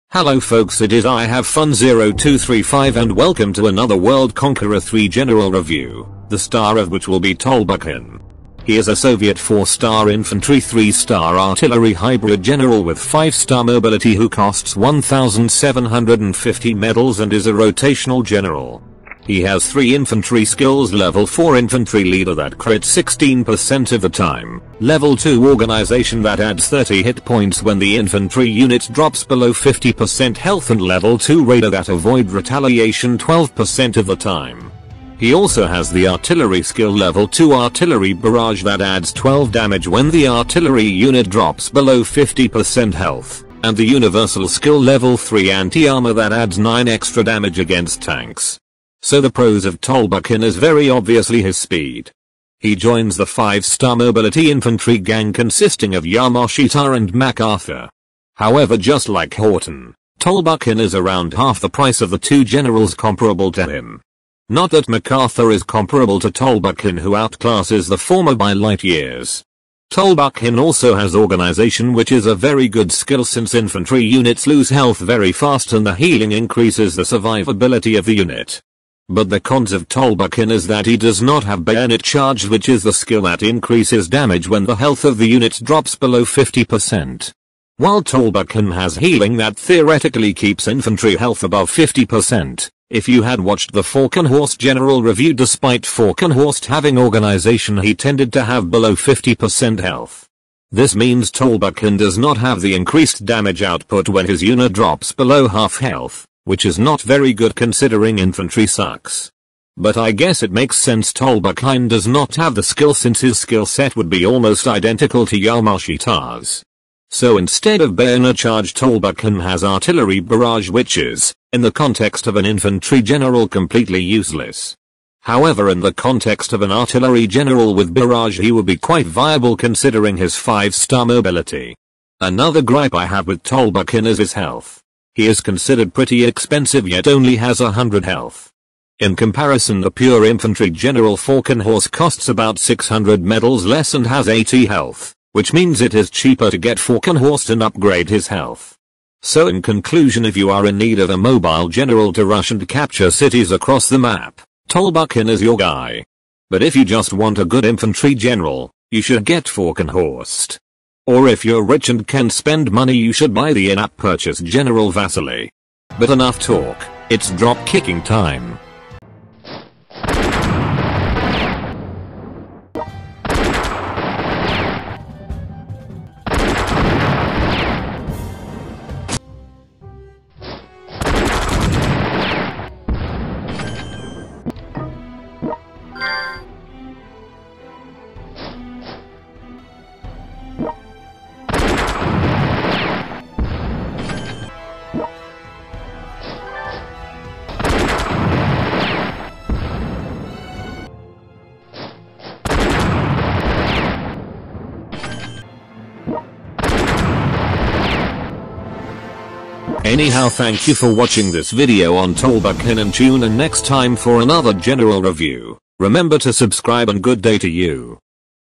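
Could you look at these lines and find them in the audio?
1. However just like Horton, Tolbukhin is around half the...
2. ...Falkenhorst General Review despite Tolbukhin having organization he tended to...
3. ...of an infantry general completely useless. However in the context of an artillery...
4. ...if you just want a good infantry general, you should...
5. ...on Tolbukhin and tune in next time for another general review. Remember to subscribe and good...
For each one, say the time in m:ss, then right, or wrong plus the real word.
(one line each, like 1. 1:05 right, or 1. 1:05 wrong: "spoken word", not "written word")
1. 0:58 right
2. 1:33 wrong: "Falkenhorst", not "Tolbukhin"
3. 2:02 right
4. 2:36 right
5. 3:31 right.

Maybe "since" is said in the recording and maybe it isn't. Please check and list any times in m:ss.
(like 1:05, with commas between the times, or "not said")
1:13, 1:52.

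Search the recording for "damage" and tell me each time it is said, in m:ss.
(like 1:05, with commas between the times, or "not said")
0:39, 0:47, 1:24, 1:43.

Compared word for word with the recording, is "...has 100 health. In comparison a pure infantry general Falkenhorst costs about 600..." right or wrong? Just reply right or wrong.
right.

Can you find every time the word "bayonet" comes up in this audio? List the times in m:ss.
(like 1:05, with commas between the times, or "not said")
1:21, 1:57.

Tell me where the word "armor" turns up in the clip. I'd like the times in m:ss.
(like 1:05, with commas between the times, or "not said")
0:45.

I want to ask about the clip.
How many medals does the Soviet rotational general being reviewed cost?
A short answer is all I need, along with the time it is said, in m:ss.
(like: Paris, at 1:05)
1750, at 0:14.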